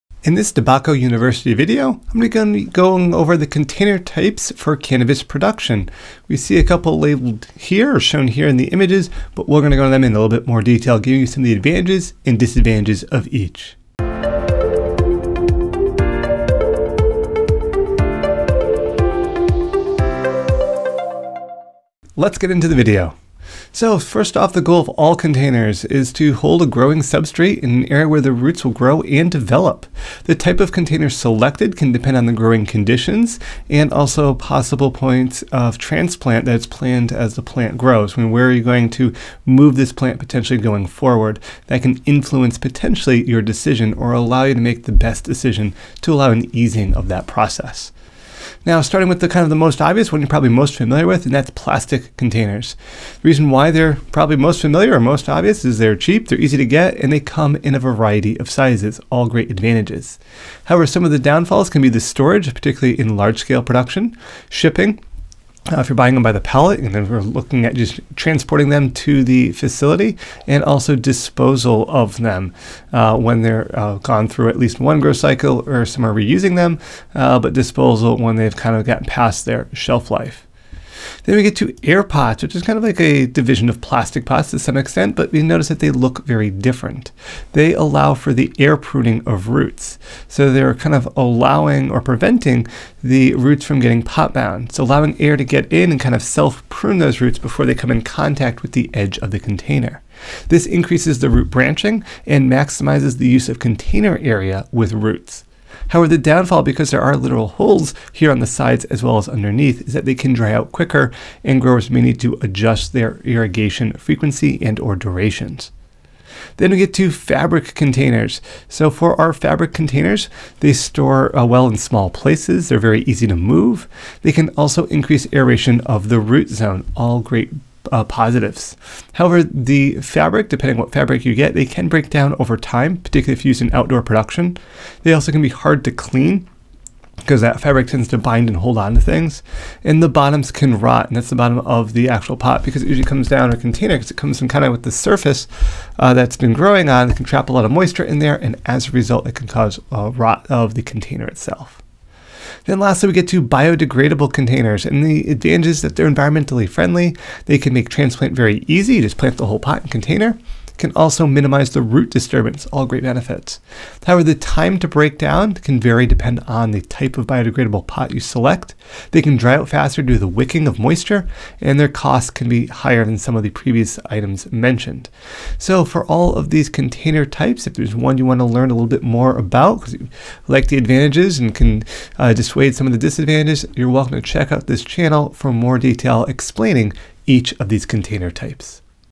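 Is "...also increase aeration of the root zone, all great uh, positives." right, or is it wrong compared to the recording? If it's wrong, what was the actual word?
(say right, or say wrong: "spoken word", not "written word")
right.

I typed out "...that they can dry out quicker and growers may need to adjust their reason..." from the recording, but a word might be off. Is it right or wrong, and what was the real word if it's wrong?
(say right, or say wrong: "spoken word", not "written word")
wrong: "irrigation", not "reason".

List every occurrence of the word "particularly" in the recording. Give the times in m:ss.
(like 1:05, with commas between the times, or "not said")
1:02, 2:12.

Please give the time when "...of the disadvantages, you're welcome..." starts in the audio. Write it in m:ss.
3:02.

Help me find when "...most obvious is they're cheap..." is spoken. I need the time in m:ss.
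0:54.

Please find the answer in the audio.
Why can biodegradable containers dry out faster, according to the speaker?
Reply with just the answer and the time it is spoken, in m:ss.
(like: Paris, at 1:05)
Wicking of moisture, at 2:50.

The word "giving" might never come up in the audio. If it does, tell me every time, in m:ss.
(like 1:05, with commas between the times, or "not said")
0:10.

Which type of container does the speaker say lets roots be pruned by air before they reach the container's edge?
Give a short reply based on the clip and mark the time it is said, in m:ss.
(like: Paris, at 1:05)
Air Pots, at 1:21.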